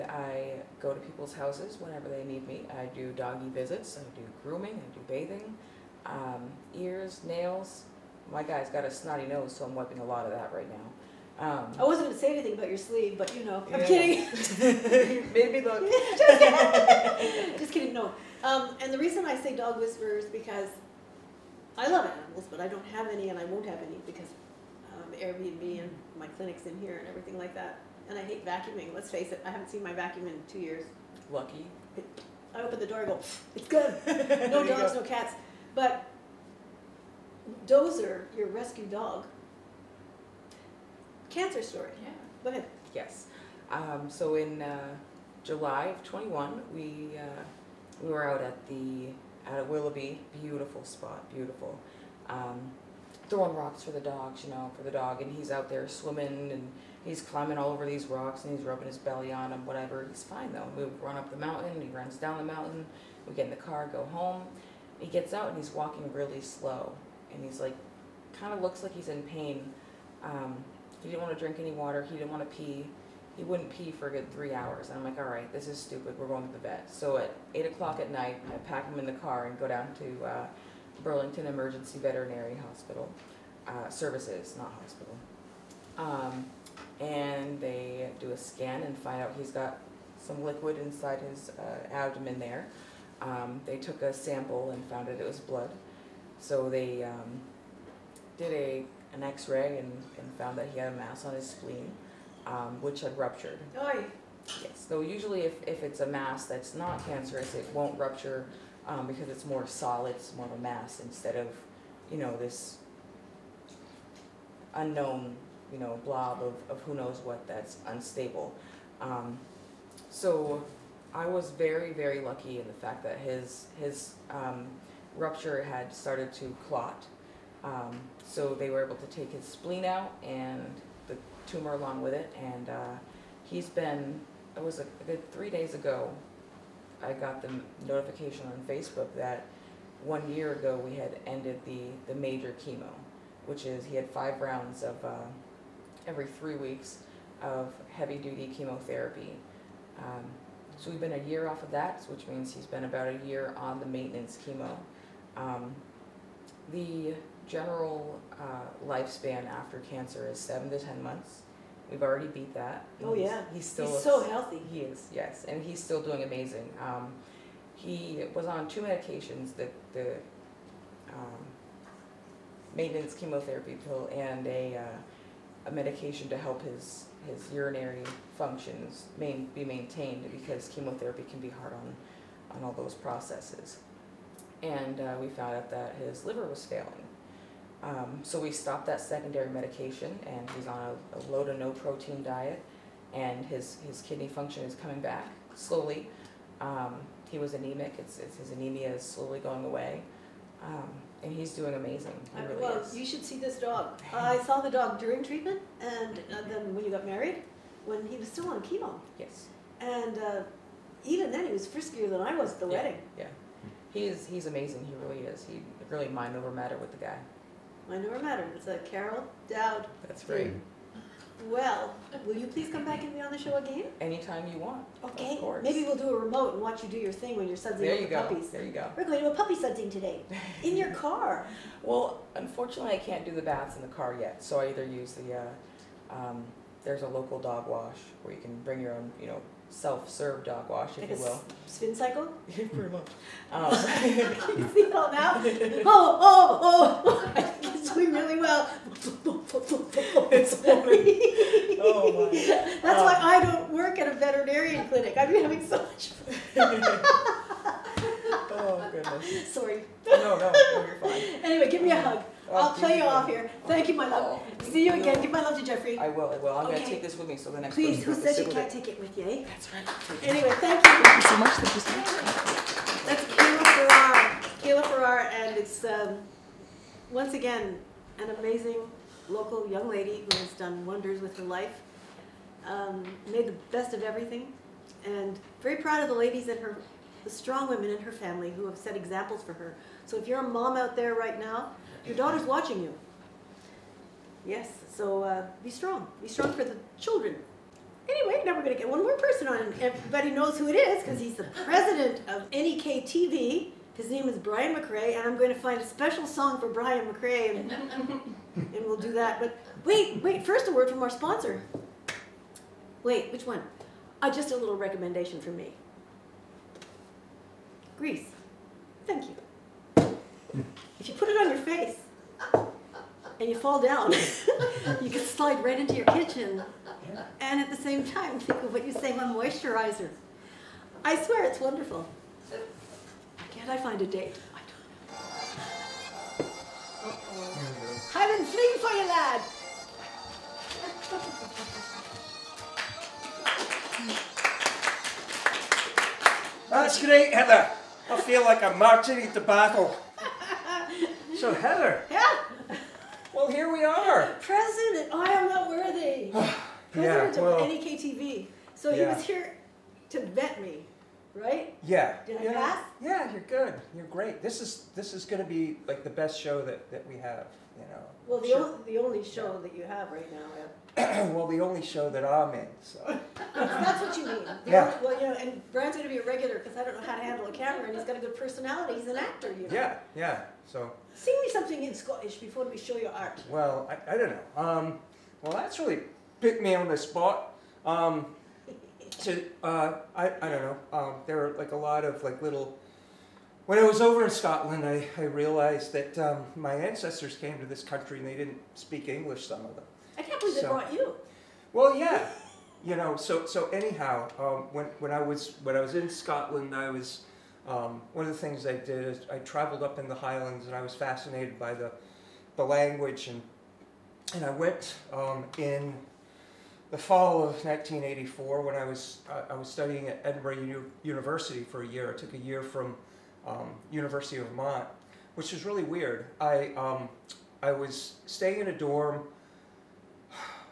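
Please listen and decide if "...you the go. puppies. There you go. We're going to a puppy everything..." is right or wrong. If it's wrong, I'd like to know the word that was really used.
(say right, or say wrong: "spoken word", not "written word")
wrong: "sudsing", not "everything".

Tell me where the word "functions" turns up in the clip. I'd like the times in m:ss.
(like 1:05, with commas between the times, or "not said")
2:58, 3:14.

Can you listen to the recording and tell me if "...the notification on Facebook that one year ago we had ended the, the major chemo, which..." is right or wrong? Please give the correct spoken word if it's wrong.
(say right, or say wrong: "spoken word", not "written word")
right.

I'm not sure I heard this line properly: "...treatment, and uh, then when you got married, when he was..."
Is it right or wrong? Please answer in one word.
right.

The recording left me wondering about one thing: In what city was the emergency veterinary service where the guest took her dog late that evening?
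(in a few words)
Burlington.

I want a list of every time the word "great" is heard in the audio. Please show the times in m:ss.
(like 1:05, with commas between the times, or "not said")
5:47, 6:04.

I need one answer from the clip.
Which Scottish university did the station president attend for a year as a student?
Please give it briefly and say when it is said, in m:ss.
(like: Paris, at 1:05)
Edinburgh University, at 7:00.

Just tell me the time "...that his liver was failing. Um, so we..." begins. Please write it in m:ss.
3:05.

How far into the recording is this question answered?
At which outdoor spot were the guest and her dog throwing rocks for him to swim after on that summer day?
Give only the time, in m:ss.
0:49.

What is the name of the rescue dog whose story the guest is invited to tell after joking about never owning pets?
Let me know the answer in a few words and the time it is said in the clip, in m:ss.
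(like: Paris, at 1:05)
Dozer, at 0:37.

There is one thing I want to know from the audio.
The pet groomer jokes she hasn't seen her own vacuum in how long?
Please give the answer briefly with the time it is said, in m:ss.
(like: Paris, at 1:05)
2 years, at 0:30.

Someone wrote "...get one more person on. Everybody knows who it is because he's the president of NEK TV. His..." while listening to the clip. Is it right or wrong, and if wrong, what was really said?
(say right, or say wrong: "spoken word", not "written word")
right.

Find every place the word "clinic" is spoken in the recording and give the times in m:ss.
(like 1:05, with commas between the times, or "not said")
0:26, 4:14.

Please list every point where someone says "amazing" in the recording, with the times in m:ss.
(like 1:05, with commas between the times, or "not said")
2:46, 3:21, 3:34, 4:38.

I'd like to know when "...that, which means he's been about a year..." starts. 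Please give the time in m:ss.
2:31.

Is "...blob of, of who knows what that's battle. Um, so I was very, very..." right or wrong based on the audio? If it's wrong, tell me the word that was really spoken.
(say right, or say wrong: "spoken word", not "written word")
wrong: "unstable", not "battle".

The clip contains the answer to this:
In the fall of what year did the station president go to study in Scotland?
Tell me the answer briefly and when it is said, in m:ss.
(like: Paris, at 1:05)
1984, at 6:57.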